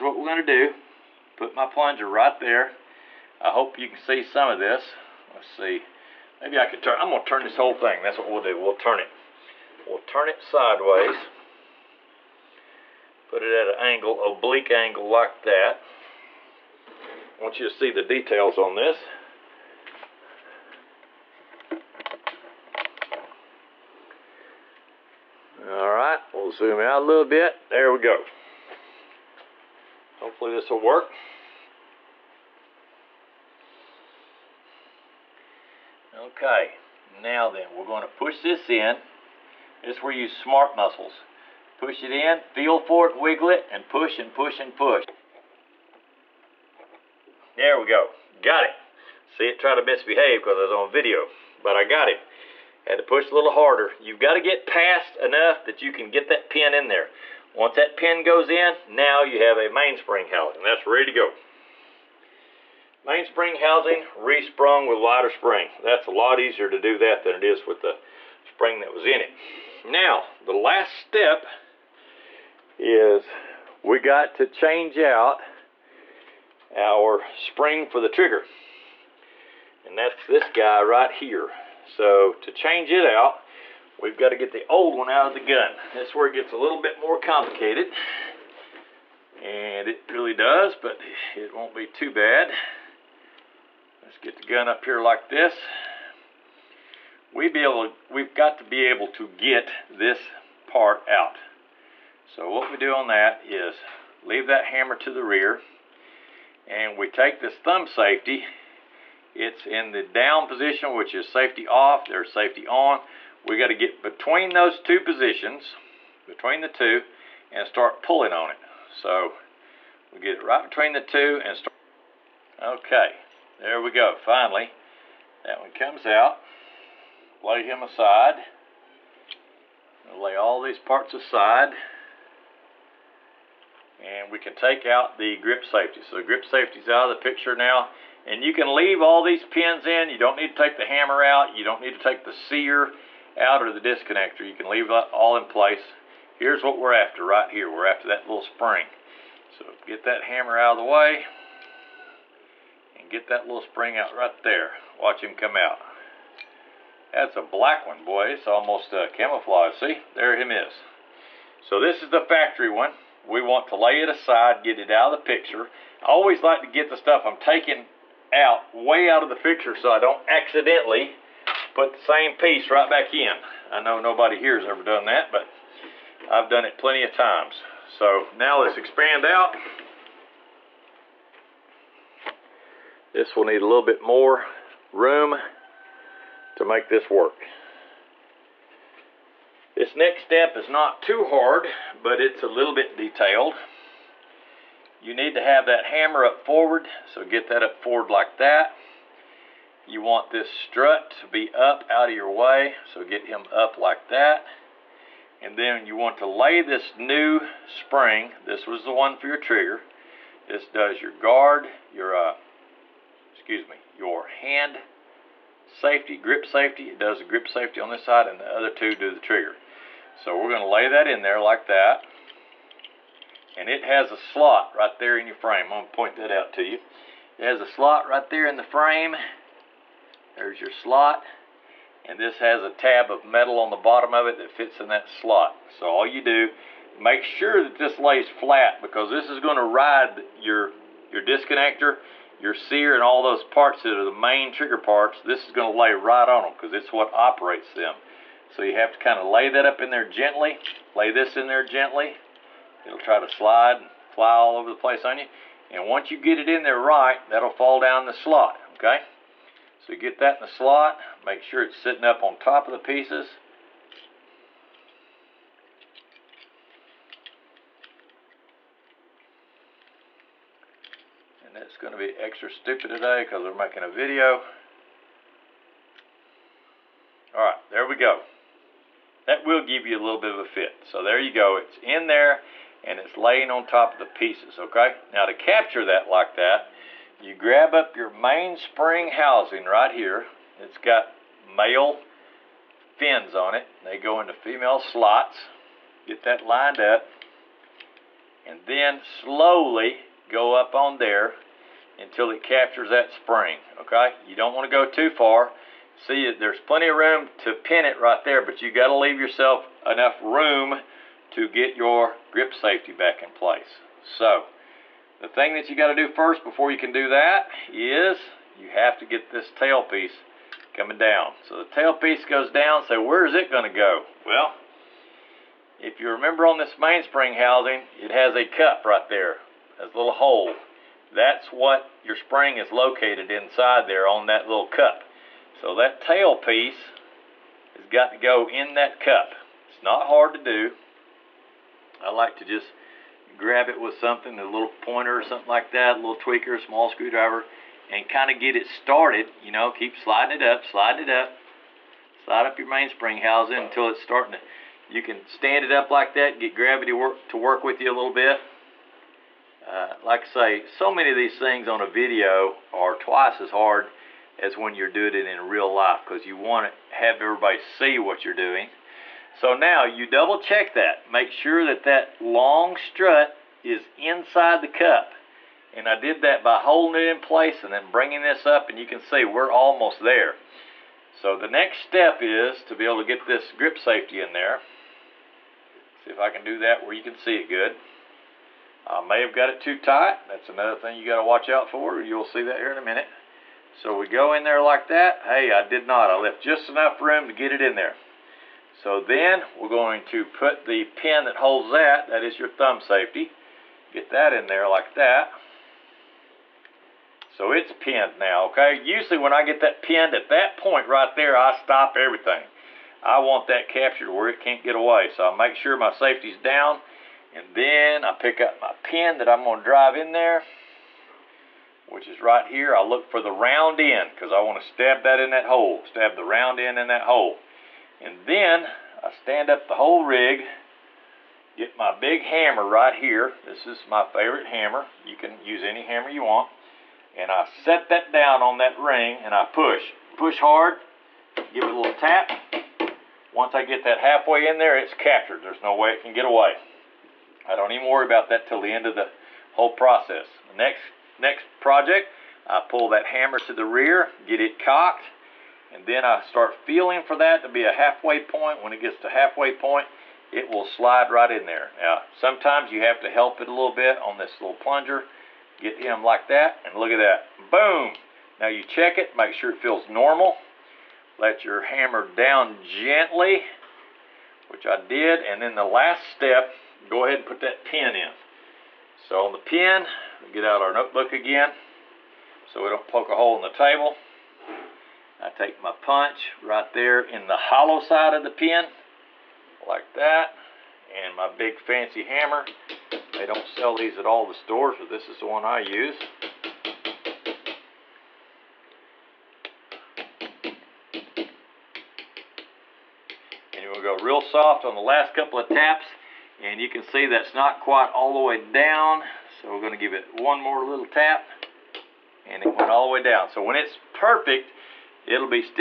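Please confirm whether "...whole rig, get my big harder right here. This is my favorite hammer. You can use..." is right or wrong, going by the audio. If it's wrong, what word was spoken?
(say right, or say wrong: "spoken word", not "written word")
wrong: "hammer", not "harder".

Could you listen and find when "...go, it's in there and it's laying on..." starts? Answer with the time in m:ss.
4:41.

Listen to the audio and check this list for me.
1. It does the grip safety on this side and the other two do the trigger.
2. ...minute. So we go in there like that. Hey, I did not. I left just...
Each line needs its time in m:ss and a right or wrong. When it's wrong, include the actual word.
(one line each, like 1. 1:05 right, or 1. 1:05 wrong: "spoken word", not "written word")
1. 3:36 right
2. 6:32 right.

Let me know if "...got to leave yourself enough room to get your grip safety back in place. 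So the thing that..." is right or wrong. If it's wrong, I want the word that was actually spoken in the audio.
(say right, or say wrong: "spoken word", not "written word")
right.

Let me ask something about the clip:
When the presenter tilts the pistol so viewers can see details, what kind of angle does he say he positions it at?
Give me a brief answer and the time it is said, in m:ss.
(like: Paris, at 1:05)
oblique angle, at 0:14.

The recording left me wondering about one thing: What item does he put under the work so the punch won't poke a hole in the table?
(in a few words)
notebook.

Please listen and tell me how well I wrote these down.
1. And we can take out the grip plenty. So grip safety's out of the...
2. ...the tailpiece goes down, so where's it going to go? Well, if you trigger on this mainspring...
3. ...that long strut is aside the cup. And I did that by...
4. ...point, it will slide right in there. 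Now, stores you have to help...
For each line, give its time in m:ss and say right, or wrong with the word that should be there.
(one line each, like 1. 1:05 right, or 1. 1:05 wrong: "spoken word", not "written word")
1. 2:13 wrong: "safety", not "plenty"
2. 5:21 wrong: "remember", not "trigger"
3. 6:11 wrong: "inside", not "aside"
4. 7:39 wrong: "sometimes", not "stores".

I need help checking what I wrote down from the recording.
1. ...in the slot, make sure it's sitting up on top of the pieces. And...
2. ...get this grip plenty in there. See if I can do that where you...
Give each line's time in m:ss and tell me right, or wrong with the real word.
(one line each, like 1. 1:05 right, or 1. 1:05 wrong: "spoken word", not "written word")
1. 4:20 right
2. 6:23 wrong: "safety", not "plenty".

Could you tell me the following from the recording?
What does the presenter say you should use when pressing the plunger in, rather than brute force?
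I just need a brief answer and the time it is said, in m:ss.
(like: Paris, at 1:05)
smart muscles, at 0:40.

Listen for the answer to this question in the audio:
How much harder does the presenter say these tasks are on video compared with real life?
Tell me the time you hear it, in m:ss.
6:02.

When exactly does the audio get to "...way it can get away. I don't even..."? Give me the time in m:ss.
7:25.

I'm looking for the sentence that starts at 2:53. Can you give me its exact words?
I know nobody here has ever done that, but I've done it plenty of times.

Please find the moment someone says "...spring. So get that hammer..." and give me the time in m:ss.
2:28.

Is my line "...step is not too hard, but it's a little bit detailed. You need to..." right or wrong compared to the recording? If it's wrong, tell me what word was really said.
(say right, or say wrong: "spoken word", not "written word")
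right.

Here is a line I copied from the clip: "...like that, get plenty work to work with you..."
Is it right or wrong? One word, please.
wrong.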